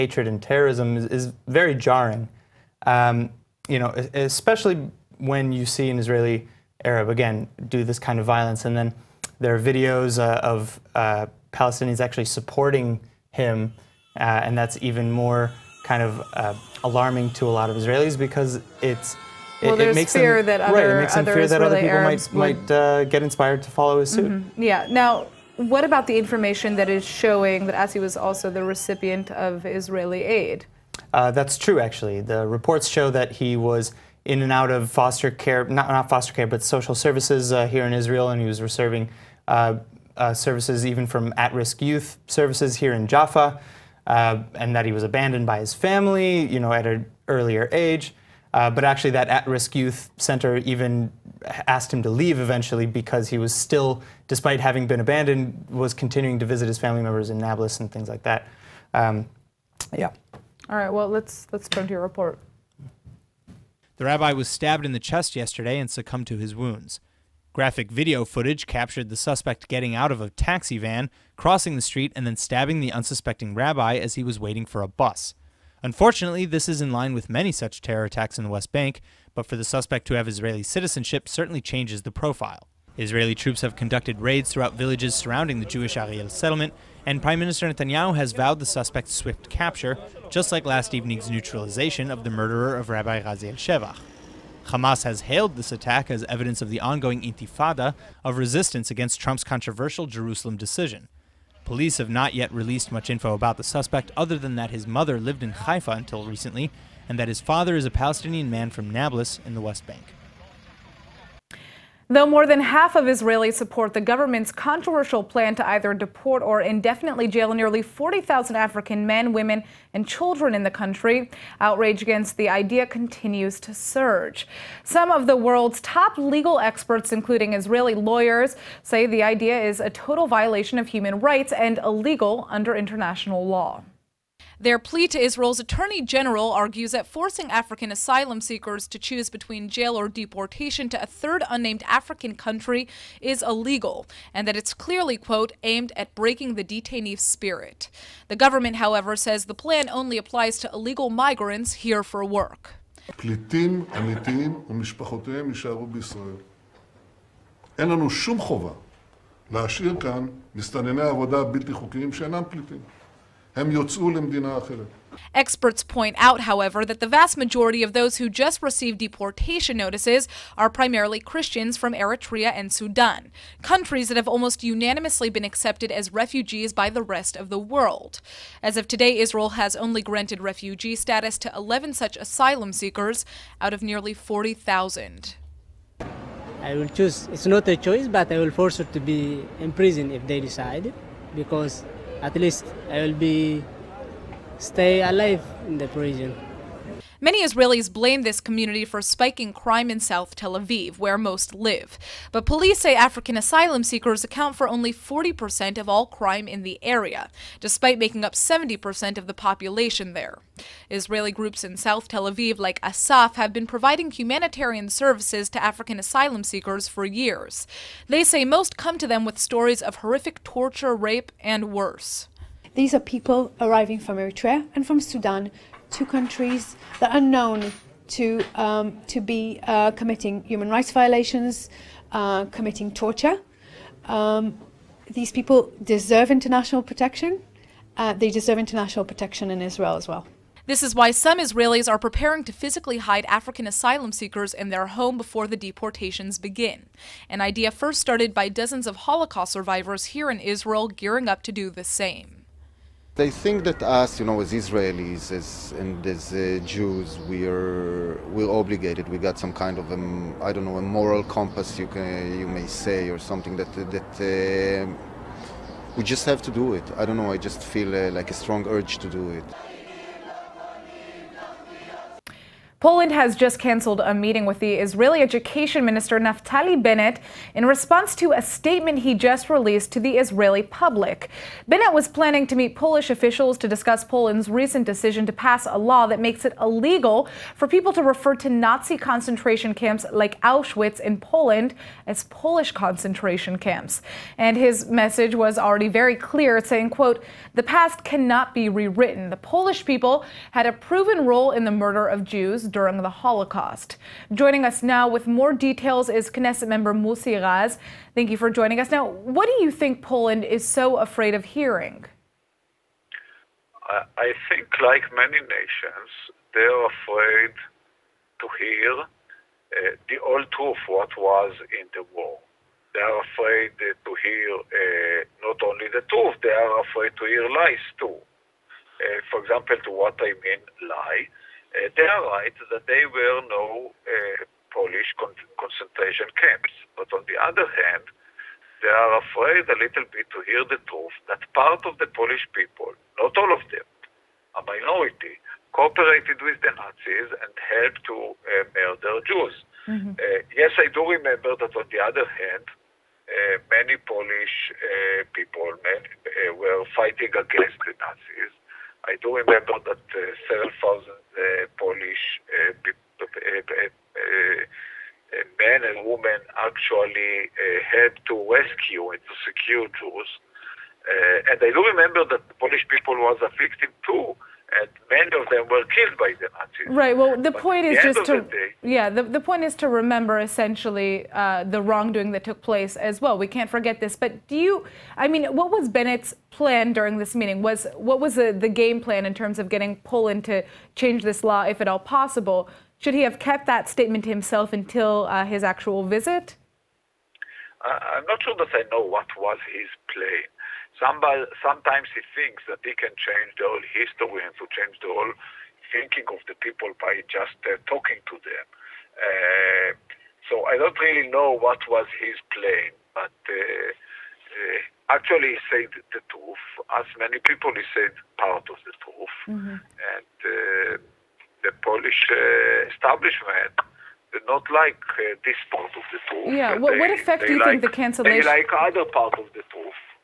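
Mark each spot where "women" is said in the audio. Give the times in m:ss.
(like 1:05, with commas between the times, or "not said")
1:59, 6:06.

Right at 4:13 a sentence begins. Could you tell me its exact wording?
They think that us, you know, as Israelis as, and as uh, Jews, we are we're obligated.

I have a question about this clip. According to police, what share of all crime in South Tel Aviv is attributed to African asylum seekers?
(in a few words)
40%.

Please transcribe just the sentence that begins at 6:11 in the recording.
and I do remember that Polish people was a victim too many of them were killed by the Nazis.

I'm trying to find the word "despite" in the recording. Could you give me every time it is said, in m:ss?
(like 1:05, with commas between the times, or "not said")
0:54, 3:27.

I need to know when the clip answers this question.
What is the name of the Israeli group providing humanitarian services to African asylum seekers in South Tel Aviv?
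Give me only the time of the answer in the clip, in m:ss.
3:32.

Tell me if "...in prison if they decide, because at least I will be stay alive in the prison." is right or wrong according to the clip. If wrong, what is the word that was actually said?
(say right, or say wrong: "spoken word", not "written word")
right.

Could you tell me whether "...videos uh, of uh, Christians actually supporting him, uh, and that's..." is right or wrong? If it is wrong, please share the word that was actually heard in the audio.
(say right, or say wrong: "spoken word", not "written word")
wrong: "Palestinians", not "Christians".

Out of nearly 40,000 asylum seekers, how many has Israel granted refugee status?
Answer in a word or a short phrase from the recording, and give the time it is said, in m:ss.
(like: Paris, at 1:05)
11, at 3:01.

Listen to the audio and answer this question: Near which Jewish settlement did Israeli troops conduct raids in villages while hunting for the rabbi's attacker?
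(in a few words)
Ariel.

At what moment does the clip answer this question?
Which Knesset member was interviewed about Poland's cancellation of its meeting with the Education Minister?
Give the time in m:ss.
5:06.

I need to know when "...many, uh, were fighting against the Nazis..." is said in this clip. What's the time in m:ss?
5:55.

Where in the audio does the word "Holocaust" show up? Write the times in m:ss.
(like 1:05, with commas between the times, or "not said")
4:08, 5:03.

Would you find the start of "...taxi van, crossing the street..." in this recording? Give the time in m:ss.
1:10.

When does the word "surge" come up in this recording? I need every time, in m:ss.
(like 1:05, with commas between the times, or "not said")
2:03.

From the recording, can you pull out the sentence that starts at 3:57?
Uh, they deserve international protection in Israel as well.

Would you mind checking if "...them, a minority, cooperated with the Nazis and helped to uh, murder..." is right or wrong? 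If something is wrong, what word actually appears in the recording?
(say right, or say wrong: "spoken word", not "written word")
right.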